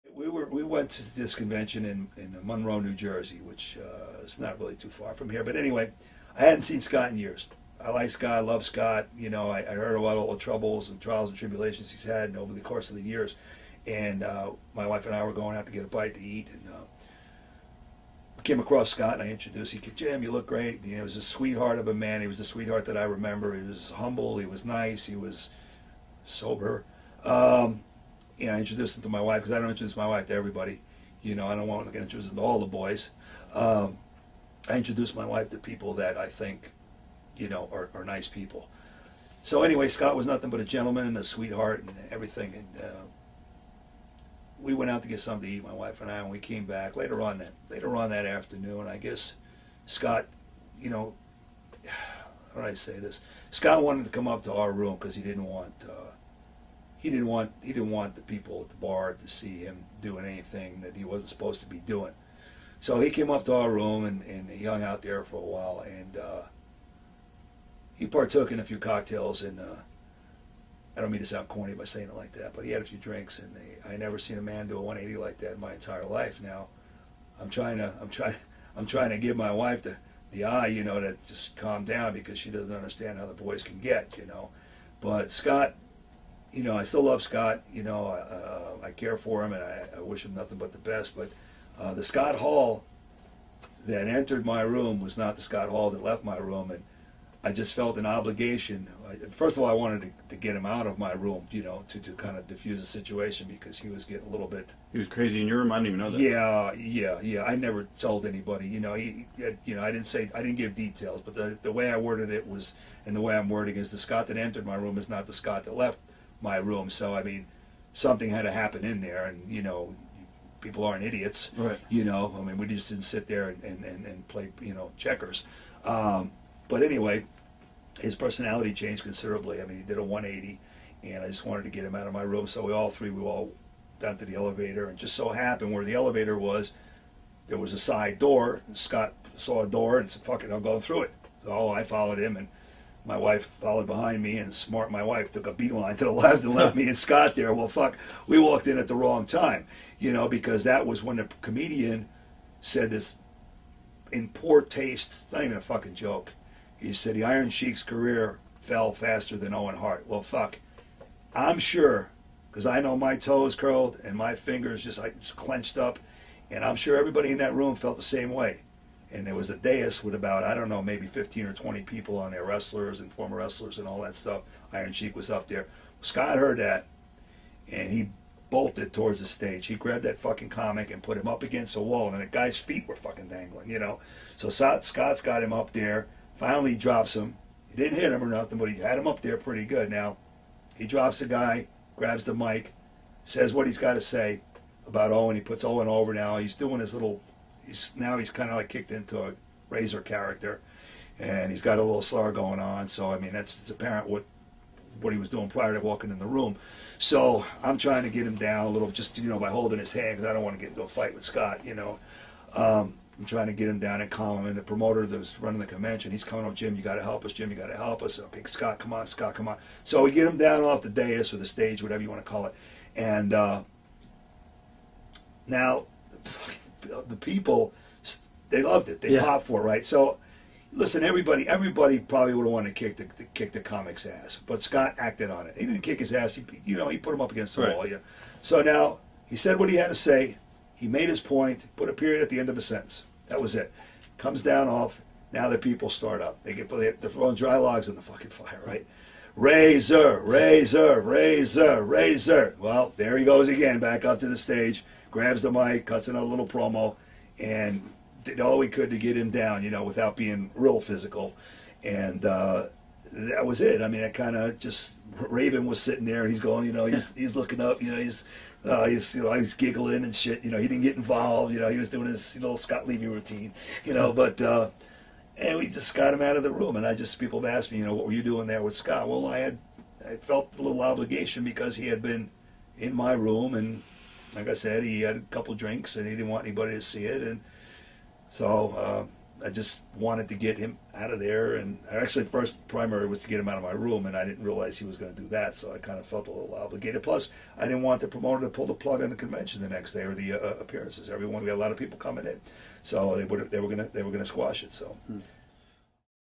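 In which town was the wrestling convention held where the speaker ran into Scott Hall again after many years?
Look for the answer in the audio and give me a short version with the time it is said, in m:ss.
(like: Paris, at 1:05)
Monroe, New Jersey, at 0:02.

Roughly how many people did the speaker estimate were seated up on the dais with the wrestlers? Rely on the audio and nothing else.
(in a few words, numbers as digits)
15 or 20.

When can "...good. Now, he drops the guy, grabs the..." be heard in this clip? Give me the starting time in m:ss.
3:09.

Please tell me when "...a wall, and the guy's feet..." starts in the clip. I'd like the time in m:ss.
3:01.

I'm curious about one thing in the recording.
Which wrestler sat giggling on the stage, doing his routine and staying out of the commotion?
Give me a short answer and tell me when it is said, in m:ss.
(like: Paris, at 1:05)
Raven, at 4:25.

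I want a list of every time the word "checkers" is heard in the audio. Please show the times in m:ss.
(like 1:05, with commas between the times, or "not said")
2:04.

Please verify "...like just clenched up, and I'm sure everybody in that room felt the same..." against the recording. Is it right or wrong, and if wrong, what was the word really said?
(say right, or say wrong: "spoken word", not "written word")
right.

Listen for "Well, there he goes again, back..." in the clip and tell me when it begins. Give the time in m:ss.
4:12.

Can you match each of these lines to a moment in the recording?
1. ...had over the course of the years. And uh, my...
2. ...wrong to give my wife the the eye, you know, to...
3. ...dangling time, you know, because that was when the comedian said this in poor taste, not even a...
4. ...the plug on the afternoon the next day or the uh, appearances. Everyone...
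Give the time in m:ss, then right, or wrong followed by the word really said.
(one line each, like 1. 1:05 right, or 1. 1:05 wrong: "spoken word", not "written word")
1. 0:12 right
2. 1:18 wrong: "trying", not "wrong"
3. 2:28 wrong: "wrong", not "dangling"
4. 4:58 wrong: "convention", not "afternoon".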